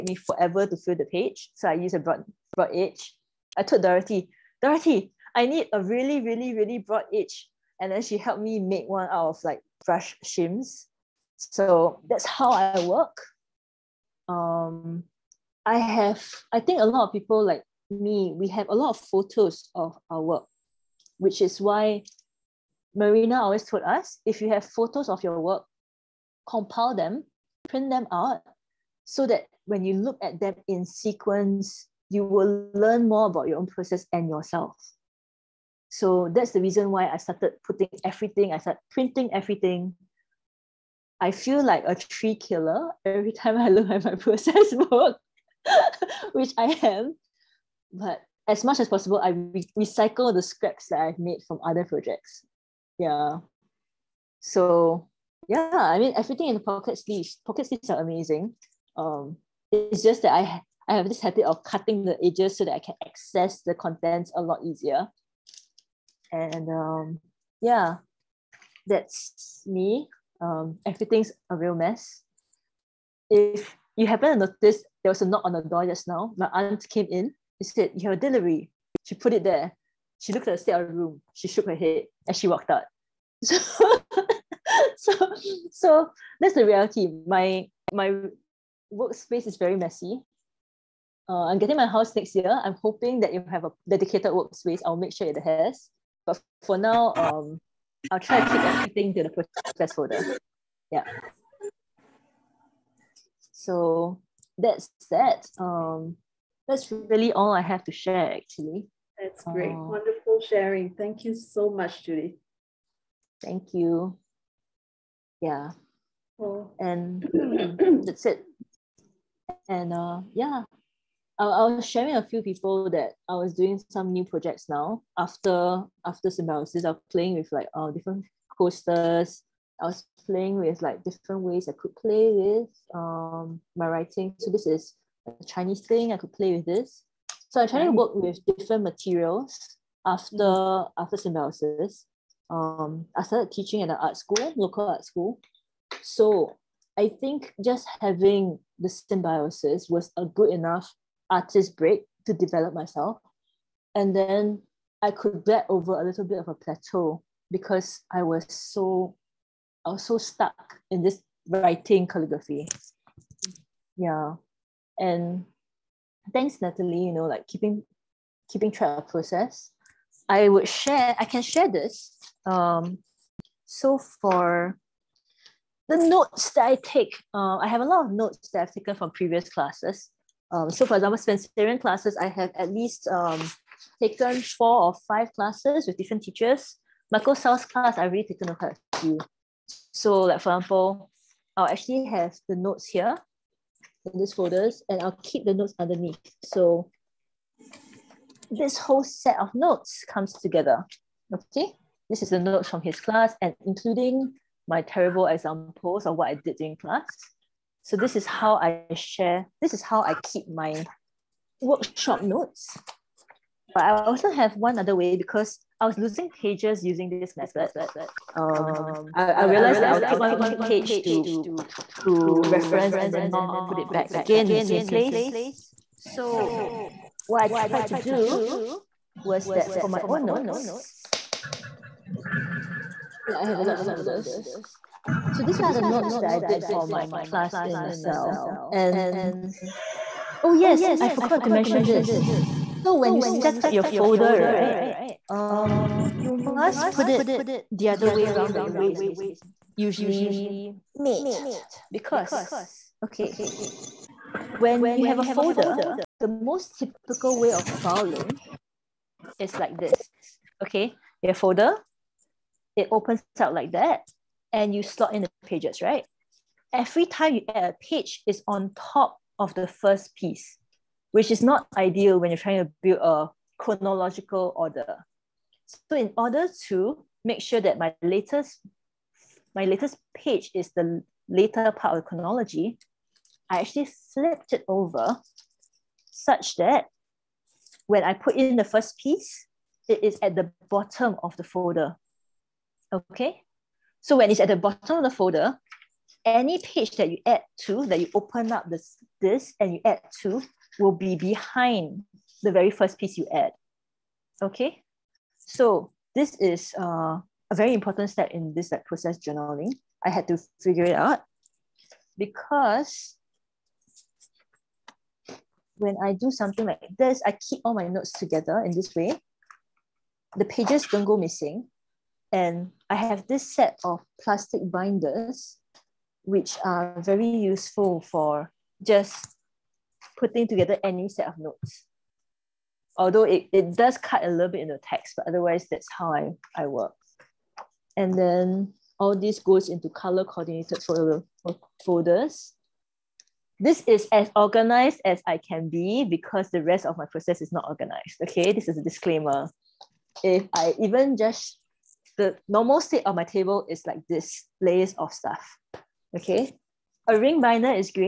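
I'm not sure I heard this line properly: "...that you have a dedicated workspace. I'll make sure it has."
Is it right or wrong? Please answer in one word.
right.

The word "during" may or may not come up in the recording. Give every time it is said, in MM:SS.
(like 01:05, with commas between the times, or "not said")
03:26.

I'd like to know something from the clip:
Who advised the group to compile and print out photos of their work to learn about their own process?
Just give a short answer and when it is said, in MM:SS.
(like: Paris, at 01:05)
Marina, at 00:22.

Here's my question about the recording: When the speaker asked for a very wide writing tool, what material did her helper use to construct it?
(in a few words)
brush shims.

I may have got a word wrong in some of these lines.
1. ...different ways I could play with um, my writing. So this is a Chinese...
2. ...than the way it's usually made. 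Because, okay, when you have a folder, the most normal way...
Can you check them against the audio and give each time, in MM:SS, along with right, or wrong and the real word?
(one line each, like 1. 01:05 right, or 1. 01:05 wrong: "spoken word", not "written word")
1. 02:11 right
2. 04:08 wrong: "typical", not "normal".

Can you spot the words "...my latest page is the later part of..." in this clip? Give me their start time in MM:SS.
04:39.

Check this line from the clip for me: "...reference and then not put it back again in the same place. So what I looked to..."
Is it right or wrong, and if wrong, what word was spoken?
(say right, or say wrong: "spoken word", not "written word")
wrong: "tried", not "looked".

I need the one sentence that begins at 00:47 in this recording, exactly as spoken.
But as much as possible, I re- recycle the scraps that I've made from other projects.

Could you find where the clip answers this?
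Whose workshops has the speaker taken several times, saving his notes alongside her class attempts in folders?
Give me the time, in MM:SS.
03:07.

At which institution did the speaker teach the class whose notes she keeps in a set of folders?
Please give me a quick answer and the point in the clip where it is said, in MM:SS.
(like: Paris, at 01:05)
LaSalle, at 03:57.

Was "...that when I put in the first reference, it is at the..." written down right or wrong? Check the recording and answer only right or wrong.
wrong.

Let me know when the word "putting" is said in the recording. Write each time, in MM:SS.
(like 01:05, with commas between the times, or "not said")
00:37, 05:30.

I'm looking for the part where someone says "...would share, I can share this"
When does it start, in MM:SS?
02:50.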